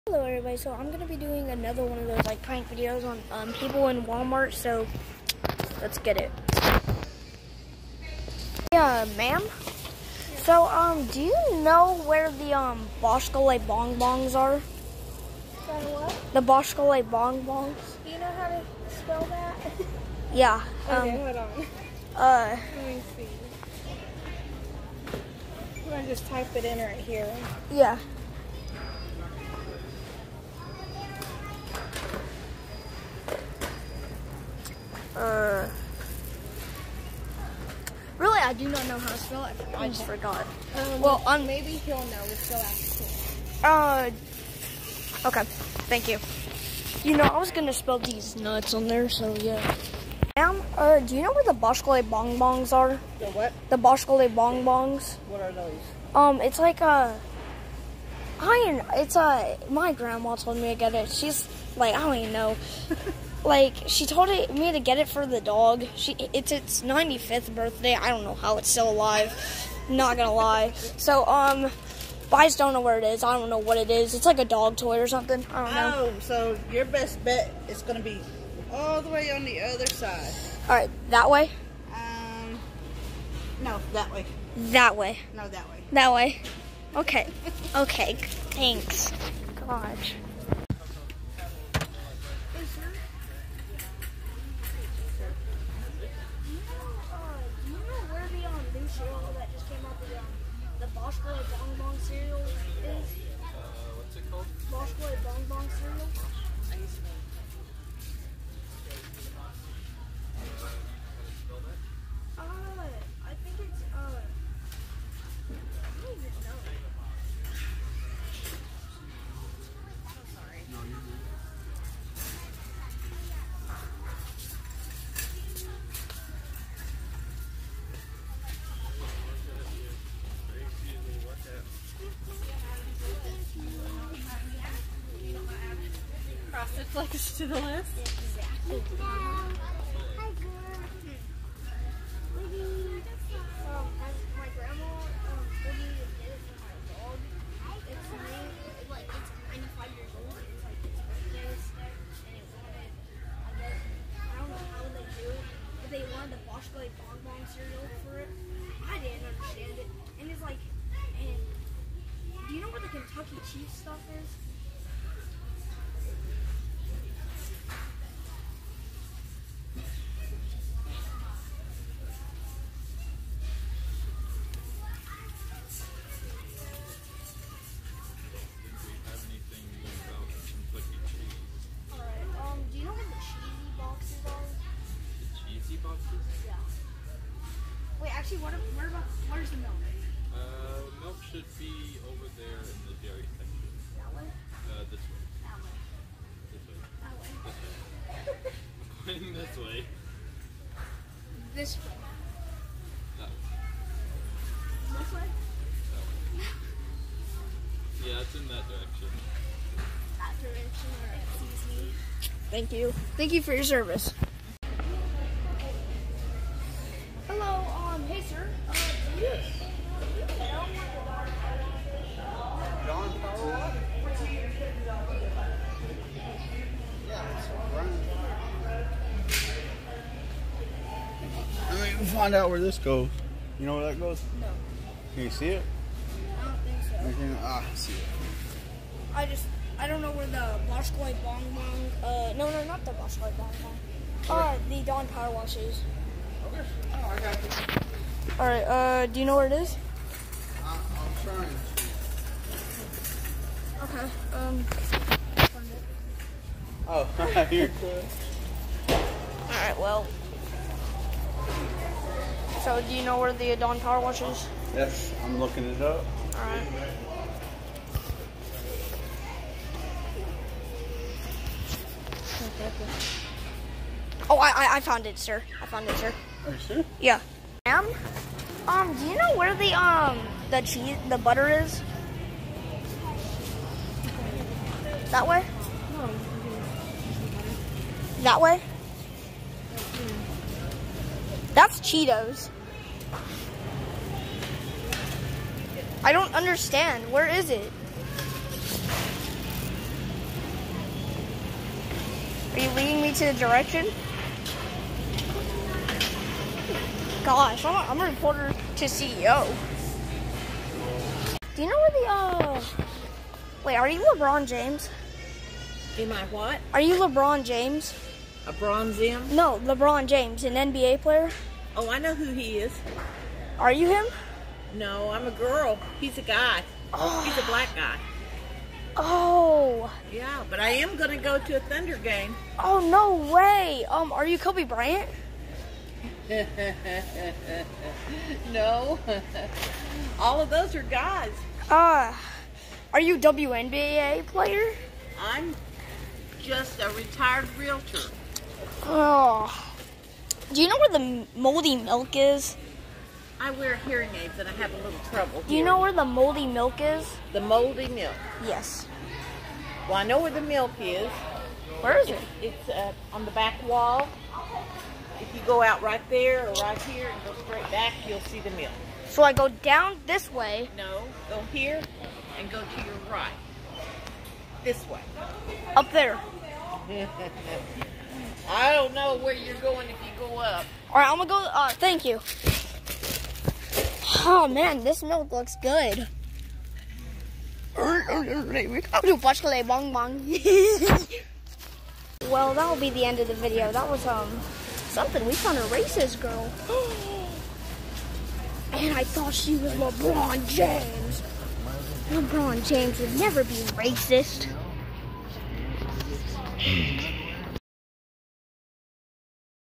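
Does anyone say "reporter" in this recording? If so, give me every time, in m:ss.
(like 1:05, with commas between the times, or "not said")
5:08.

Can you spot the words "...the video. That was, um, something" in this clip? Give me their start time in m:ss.
6:33.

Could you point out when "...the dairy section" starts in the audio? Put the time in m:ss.
3:12.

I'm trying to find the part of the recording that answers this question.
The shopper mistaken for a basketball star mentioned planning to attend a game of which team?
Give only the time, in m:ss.
5:31.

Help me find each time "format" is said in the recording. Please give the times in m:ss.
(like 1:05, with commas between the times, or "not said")
not said.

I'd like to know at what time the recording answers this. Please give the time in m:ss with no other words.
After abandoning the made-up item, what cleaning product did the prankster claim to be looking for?
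4:04.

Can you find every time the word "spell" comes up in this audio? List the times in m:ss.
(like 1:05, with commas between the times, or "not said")
0:18, 0:39, 0:47.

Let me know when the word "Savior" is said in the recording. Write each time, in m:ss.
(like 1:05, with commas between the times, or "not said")
not said.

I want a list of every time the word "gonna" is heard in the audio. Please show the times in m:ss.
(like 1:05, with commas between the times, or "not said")
0:47, 1:10, 1:17, 6:21.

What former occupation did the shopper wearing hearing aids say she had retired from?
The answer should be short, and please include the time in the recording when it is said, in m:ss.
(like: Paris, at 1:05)
realtor, at 5:47.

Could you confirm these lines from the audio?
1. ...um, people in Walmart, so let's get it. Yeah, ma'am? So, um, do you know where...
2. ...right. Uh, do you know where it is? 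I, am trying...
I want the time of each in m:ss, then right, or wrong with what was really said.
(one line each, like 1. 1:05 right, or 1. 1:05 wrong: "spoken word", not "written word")
1. 0:03 right
2. 4:08 right.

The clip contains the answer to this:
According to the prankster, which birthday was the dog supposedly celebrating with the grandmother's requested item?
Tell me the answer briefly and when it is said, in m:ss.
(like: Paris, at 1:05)
95th, at 1:06.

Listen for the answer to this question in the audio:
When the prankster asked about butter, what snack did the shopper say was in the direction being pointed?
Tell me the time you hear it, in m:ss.
4:51.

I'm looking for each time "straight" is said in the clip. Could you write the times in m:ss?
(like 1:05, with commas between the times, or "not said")
6:07.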